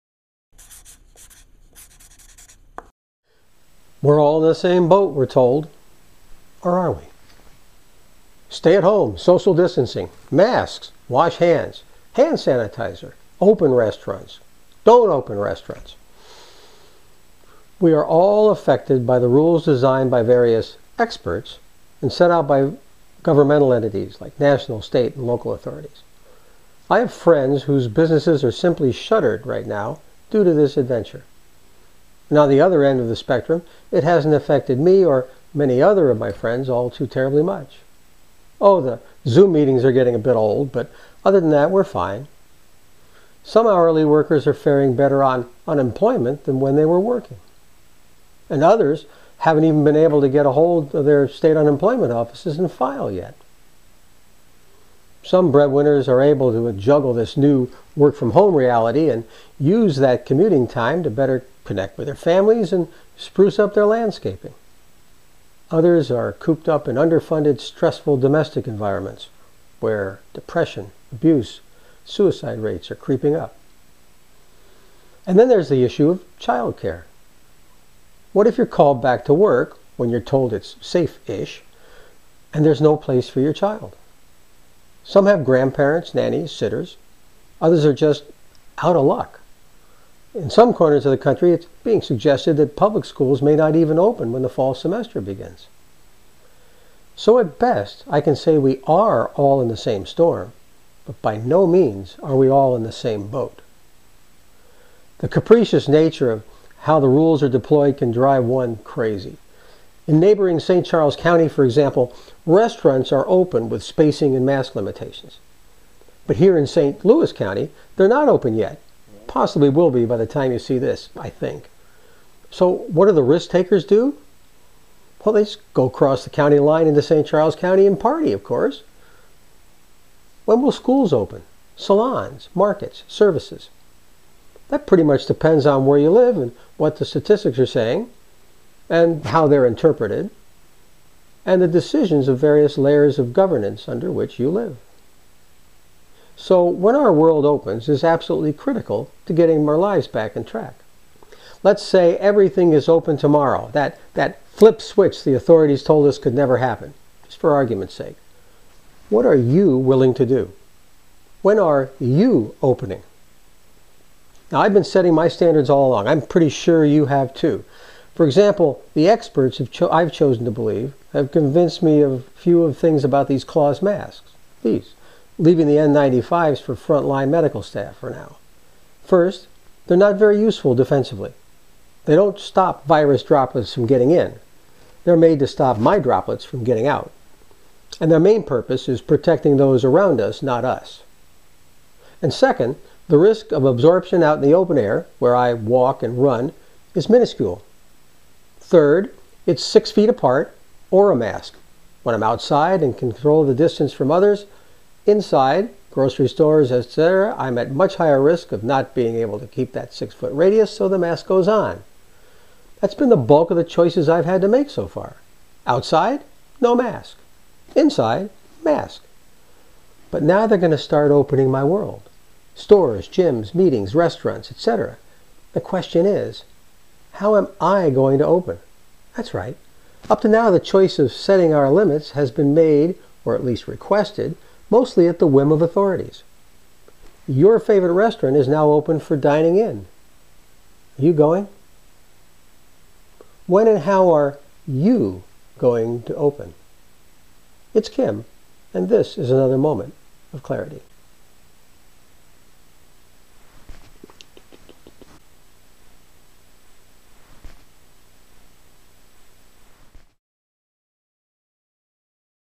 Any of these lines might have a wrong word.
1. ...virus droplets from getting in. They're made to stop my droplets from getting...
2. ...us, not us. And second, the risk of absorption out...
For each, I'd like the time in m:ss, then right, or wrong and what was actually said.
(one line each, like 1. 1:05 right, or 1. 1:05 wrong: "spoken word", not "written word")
1. 3:02 right
2. 3:10 right.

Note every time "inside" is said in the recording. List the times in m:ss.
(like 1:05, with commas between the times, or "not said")
3:25, 3:37.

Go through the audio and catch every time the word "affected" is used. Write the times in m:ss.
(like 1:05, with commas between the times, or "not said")
0:18, 0:34.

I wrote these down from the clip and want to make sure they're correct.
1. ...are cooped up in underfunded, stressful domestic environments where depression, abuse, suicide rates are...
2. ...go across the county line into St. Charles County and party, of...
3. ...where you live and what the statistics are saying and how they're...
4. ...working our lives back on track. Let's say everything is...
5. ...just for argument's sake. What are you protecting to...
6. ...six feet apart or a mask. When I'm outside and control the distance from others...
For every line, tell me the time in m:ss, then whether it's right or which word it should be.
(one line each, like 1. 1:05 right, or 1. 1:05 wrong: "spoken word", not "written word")
1. 1:06 right
2. 2:05 right
3. 2:15 right
4. 2:29 wrong: "getting", not "working"
5. 2:37 wrong: "willing", not "protecting"
6. 3:19 right.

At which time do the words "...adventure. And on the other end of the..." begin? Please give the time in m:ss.
0:30.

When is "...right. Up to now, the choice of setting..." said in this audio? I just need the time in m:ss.
3:49.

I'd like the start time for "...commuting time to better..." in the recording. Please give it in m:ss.
1:00.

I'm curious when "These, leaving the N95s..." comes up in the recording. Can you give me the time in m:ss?
2:54.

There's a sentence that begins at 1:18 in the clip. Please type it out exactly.
What if you're called back to work when you're told it's safe ish and there's no place for your child?